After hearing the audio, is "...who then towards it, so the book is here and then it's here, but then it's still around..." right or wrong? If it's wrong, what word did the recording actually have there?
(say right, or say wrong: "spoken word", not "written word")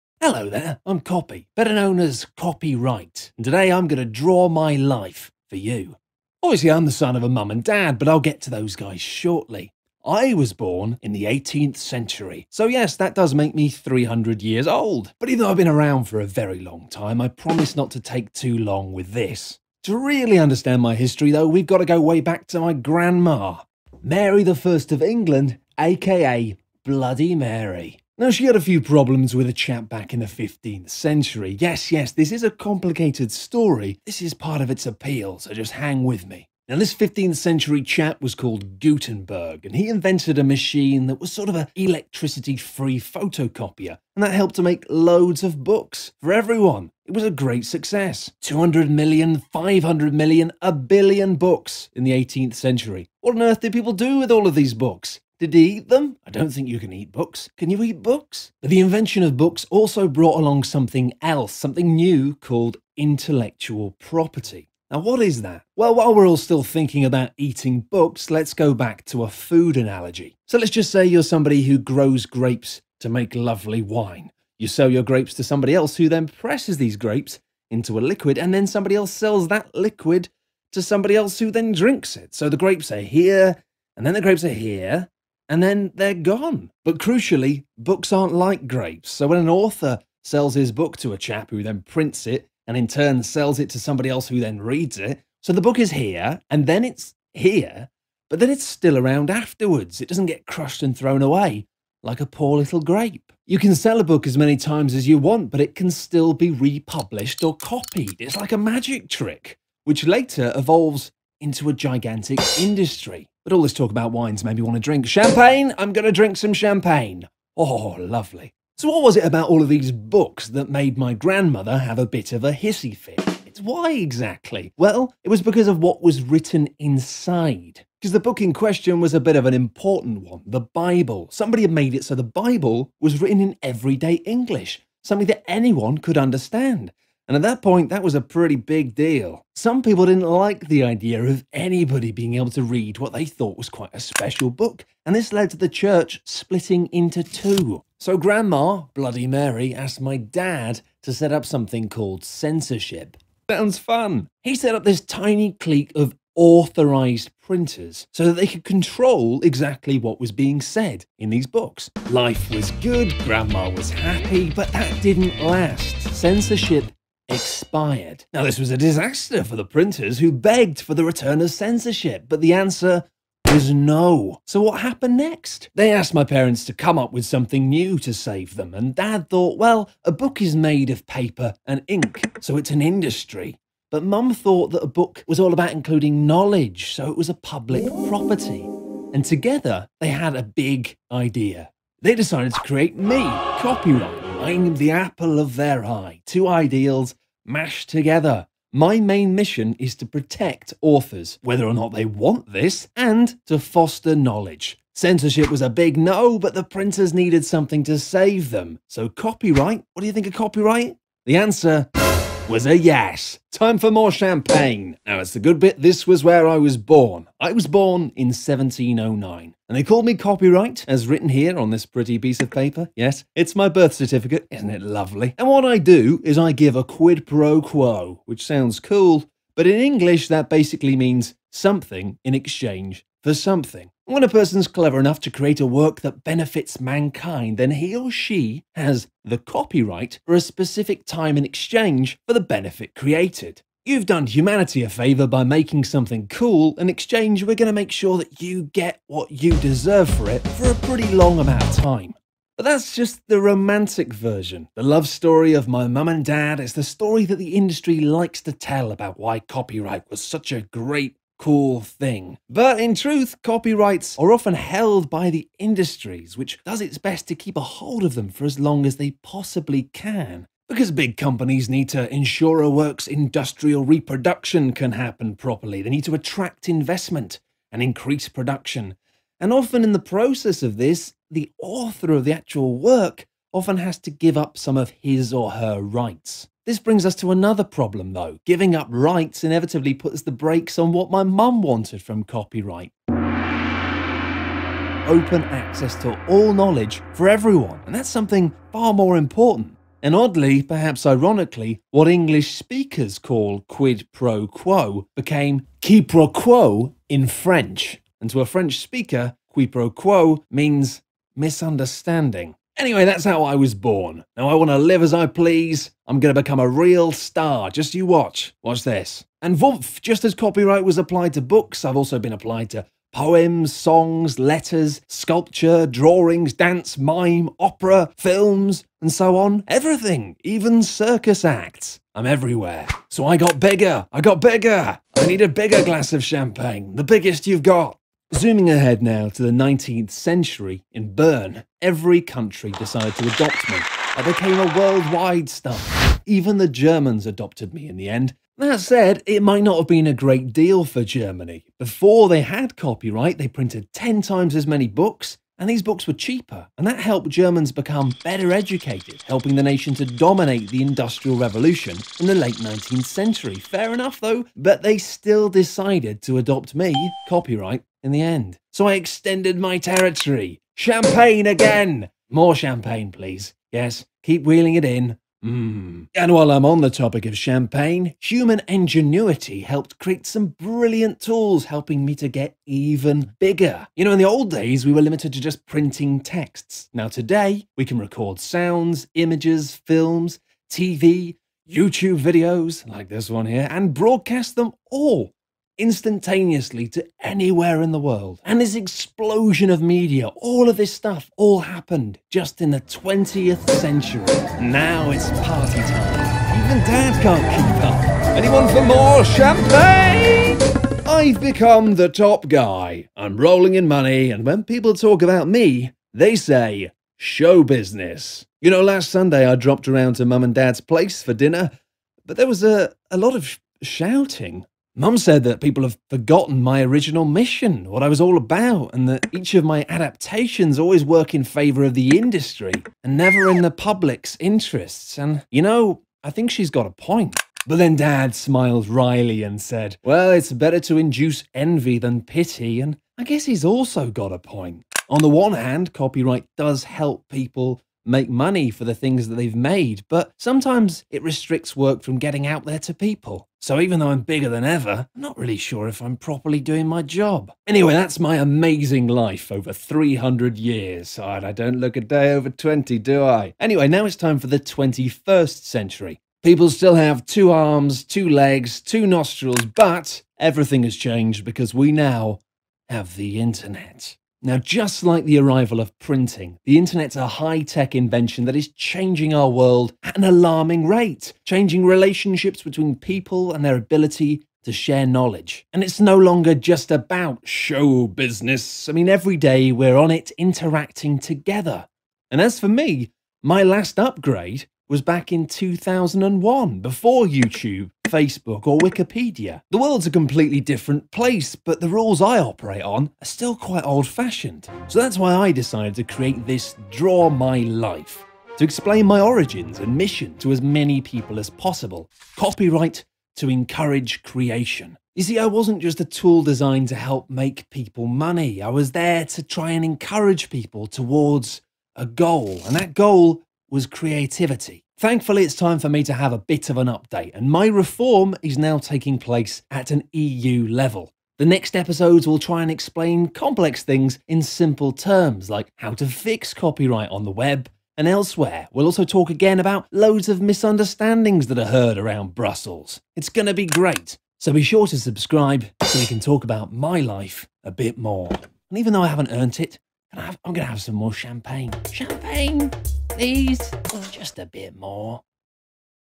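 wrong: "reads", not "towards".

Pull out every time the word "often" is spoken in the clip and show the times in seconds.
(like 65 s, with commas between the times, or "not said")
264 s, 279 s, 283 s.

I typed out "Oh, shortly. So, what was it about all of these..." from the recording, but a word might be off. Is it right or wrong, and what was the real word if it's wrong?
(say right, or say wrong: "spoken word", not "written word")
wrong: "lovely", not "shortly".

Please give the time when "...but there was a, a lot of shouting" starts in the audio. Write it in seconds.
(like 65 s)
422 s.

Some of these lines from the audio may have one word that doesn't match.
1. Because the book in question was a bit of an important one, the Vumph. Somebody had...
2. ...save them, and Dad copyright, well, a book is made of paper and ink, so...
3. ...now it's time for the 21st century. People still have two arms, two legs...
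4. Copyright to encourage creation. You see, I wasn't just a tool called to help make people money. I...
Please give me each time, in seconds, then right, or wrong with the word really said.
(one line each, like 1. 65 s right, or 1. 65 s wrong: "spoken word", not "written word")
1. 127 s wrong: "Bible", not "Vumph"
2. 178 s wrong: "thought", not "copyright"
3. 463 s right
4. 512 s wrong: "designed", not "called".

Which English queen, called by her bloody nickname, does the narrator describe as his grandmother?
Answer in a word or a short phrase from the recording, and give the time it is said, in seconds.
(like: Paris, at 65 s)
Mary I of England, at 24 s.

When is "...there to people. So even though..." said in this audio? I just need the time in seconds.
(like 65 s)
452 s.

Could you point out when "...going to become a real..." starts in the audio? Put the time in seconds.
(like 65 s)
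316 s.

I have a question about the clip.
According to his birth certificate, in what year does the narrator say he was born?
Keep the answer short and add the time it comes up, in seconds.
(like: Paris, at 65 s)
1709, at 218 s.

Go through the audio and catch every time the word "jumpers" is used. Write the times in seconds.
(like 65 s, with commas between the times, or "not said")
not said.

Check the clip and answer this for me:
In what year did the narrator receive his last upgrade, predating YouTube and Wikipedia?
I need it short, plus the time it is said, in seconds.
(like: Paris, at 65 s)
2001, at 495 s.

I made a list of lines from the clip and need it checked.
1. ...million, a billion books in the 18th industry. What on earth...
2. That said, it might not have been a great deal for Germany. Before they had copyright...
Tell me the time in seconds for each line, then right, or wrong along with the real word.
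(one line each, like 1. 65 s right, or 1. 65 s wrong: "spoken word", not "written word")
1. 50 s wrong: "century", not "industry"
2. 348 s right.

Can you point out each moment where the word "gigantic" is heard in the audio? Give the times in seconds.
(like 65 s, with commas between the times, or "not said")
111 s.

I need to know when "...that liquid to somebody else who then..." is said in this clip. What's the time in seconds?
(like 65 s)
79 s.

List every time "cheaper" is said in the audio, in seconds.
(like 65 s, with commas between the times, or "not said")
356 s.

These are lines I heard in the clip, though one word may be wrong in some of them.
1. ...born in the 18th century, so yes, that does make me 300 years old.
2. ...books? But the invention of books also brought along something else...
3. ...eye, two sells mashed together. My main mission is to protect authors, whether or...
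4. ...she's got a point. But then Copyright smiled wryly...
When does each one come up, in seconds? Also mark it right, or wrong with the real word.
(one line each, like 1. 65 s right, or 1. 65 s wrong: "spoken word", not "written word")
1. 10 s right
2. 58 s right
3. 195 s wrong: "ideals", not "sells"
4. 436 s wrong: "Dad", not "Copyright".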